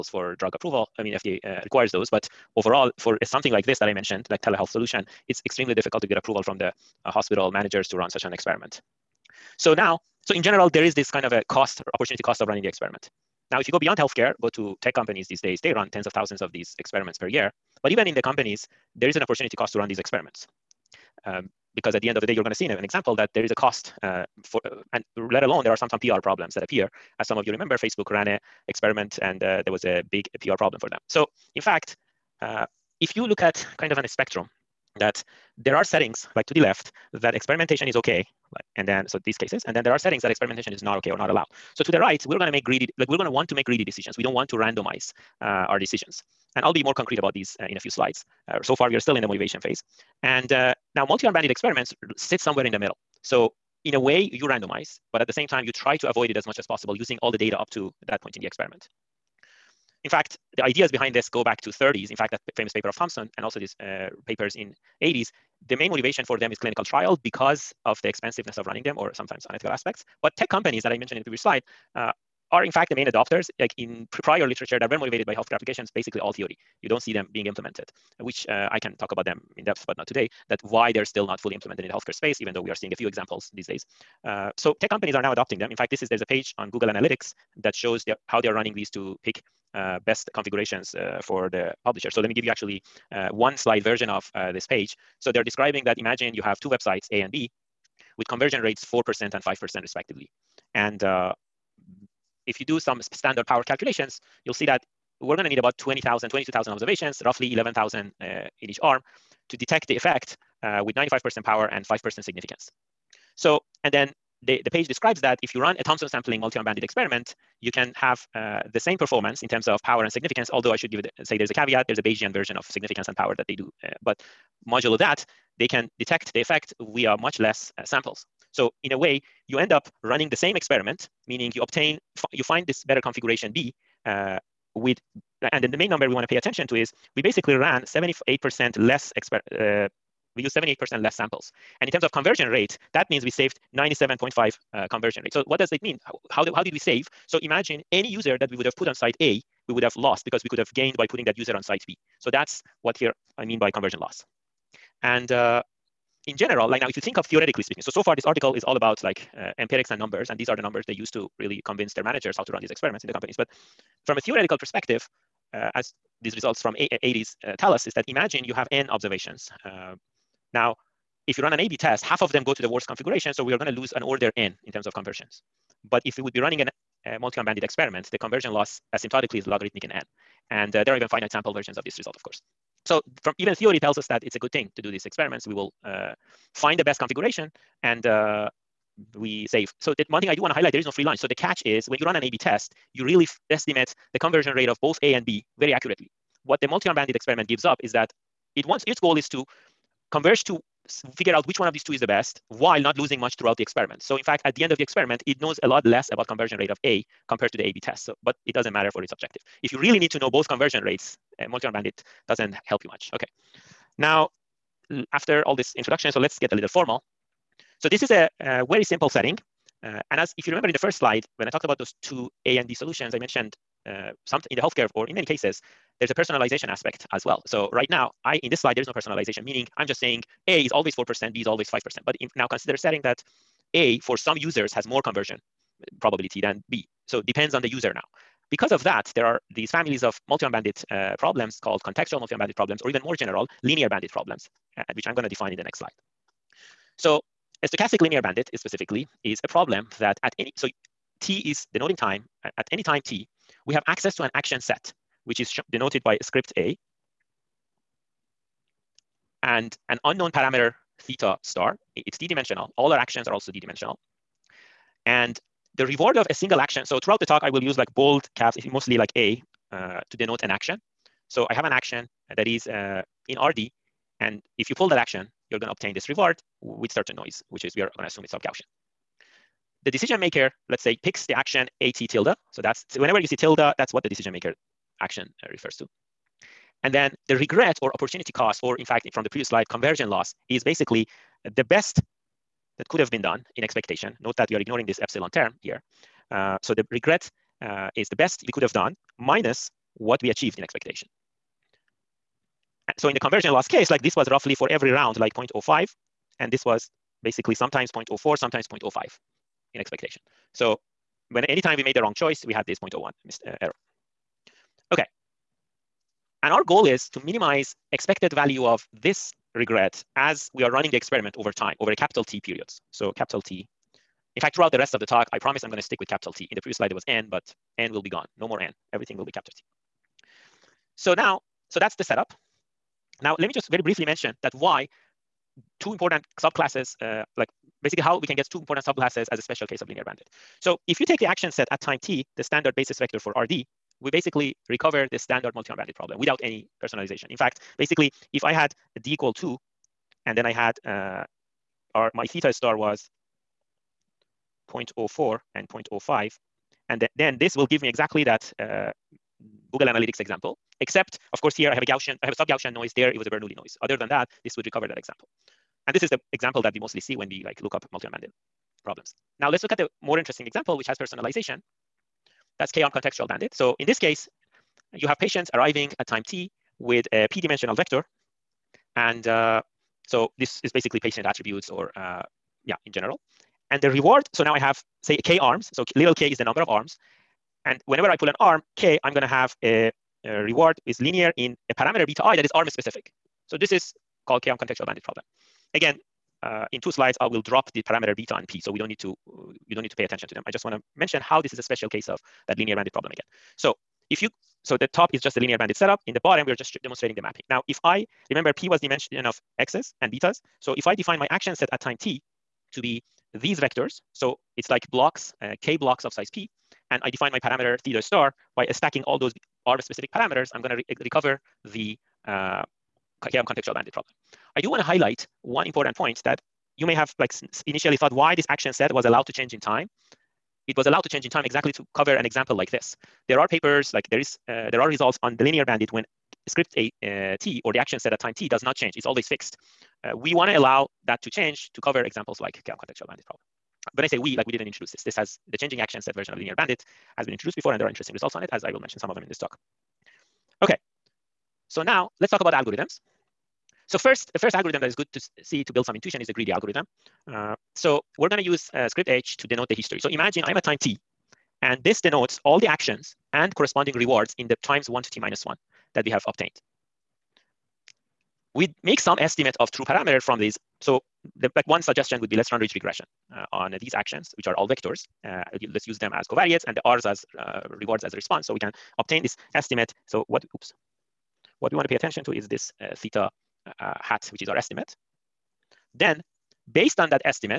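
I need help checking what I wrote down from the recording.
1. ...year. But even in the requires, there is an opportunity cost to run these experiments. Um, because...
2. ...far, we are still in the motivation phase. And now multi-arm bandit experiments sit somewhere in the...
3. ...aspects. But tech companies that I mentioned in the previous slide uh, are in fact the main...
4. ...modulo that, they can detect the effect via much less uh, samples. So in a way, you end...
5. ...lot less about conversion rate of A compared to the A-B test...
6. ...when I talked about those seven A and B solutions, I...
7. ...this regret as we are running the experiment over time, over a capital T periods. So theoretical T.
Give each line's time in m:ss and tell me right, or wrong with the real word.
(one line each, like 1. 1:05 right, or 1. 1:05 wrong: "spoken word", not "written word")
1. 0:17 wrong: "companies", not "requires"
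2. 0:48 right
3. 1:09 right
4. 2:04 right
5. 3:25 right
6. 3:41 wrong: "two", not "seven"
7. 5:19 wrong: "capital", not "theoretical".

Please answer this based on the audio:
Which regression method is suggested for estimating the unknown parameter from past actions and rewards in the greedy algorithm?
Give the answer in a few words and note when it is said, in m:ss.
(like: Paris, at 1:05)
ridge regression, at 7:52.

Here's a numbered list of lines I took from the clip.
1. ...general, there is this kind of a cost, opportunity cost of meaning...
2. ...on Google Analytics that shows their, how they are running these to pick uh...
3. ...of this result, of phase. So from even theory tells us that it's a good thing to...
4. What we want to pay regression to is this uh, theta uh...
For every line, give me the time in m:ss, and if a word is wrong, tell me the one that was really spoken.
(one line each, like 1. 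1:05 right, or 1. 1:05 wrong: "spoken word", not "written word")
1. 0:10 wrong: "running", not "meaning"
2. 1:26 right
3. 3:01 wrong: "course", not "phase"
4. 8:01 wrong: "attention", not "regression".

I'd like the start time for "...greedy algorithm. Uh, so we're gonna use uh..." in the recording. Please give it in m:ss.
7:36.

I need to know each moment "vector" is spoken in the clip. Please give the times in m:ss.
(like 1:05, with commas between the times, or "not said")
5:42, 6:17, 6:53, 7:54.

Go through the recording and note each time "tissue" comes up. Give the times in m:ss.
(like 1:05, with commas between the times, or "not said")
not said.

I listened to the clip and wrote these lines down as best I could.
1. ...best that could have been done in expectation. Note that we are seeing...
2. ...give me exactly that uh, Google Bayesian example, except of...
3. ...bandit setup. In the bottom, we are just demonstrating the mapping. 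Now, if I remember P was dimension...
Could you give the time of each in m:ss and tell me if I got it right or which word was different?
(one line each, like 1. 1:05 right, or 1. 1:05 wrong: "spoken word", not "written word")
1. 4:51 wrong: "ignoring", not "seeing"
2. 5:57 wrong: "Analytics", not "Bayesian"
3. 6:45 right.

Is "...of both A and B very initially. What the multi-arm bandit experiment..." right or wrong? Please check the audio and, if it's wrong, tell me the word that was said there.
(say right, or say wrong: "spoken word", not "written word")
wrong: "accurately", not "initially".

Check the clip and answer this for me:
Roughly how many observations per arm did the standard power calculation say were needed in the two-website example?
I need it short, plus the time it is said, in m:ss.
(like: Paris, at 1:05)
11,000, at 1:47.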